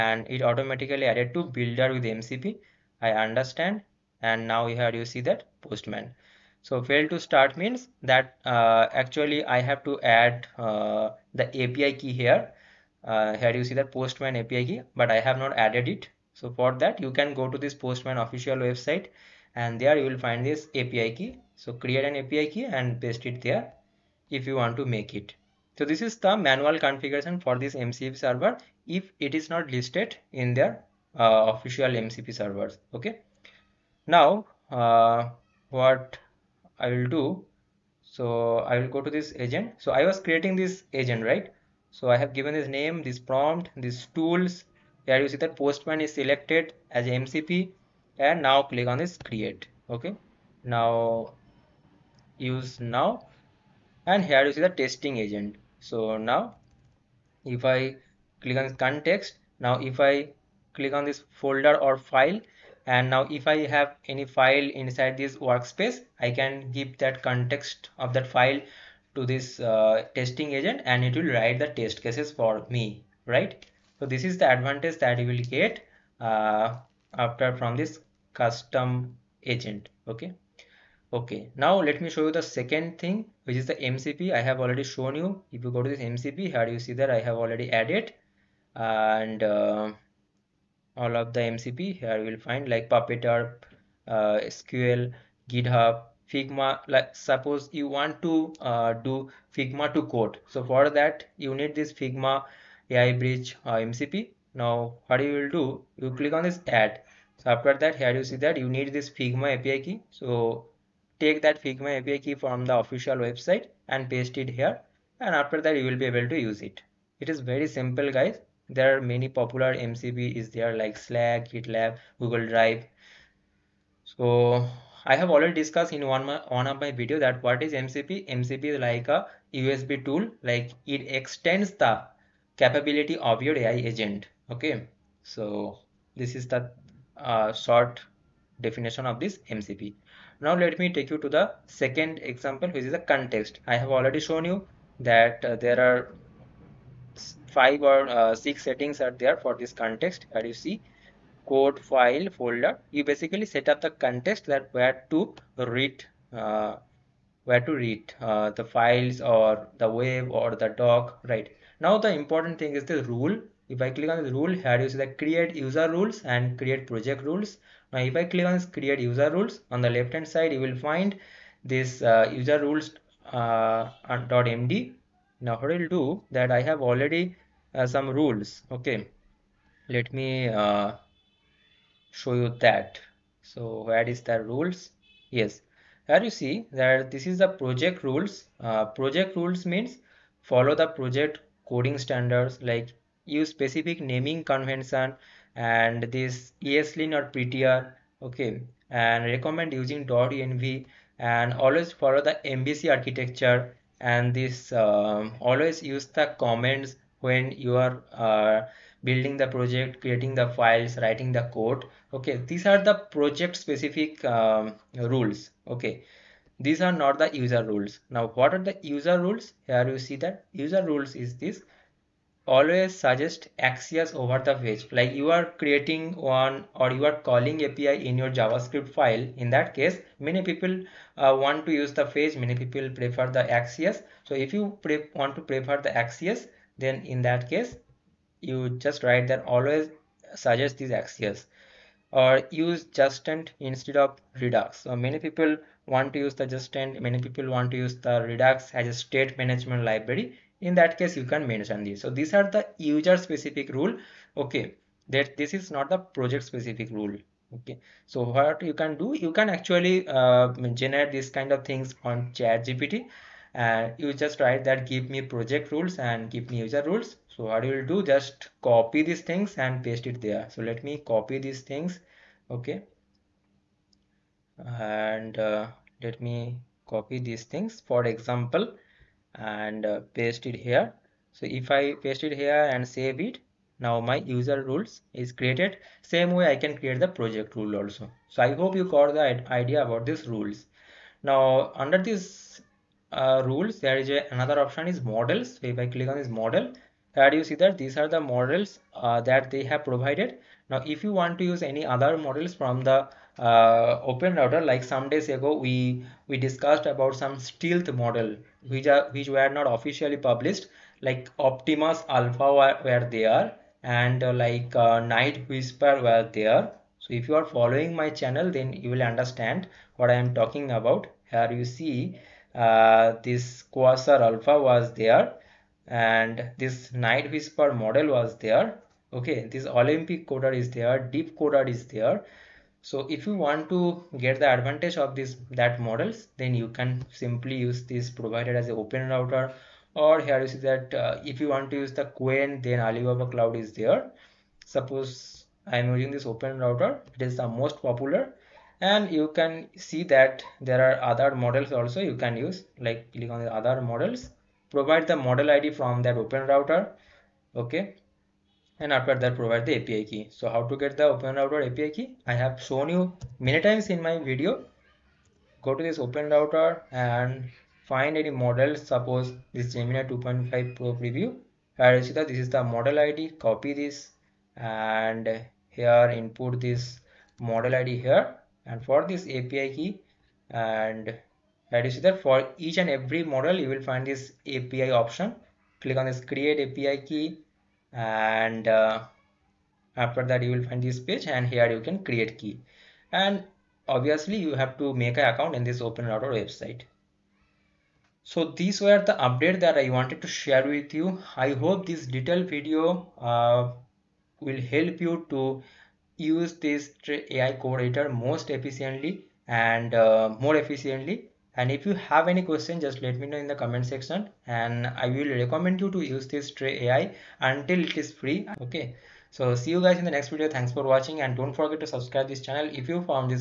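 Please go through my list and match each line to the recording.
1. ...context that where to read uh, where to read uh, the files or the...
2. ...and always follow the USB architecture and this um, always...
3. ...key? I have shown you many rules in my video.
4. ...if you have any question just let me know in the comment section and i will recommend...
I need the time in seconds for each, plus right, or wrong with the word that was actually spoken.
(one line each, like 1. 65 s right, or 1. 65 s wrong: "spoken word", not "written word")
1. 154 s right
2. 201 s wrong: "MVC", not "USB"
3. 361 s wrong: "times", not "rules"
4. 411 s right.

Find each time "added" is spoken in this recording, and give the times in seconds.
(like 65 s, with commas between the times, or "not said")
1 s, 15 s, 87 s.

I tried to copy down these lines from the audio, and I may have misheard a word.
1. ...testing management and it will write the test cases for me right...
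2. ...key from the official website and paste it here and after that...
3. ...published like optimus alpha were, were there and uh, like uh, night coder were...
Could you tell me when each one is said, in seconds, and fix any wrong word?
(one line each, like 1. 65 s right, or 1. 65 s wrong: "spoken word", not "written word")
1. 70 s wrong: "agent", not "management"
2. 112 s right
3. 310 s wrong: "whisper", not "coder".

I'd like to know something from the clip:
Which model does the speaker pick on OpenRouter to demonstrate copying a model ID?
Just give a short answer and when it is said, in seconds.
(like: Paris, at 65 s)
Gemini 2.5 Pro preview, at 369 s.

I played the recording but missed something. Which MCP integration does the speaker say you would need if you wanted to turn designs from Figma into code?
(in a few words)
Figma AI Bridge.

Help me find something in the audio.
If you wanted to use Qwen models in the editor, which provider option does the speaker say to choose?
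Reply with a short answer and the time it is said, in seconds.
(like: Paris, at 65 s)
Alibaba Cloud, at 342 s.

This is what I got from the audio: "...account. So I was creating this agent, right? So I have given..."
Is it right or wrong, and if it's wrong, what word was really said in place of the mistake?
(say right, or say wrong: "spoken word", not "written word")
wrong: "agent", not "account".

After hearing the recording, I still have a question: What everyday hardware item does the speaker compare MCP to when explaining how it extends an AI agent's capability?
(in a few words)
USB tool.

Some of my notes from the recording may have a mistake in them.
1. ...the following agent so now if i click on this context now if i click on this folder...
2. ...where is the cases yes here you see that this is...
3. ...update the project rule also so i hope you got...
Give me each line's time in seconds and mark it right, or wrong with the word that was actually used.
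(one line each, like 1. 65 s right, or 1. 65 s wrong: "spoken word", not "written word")
1. 54 s wrong: "testing", not "following"
2. 183 s wrong: "rules", not "cases"
3. 286 s wrong: "create", not "update".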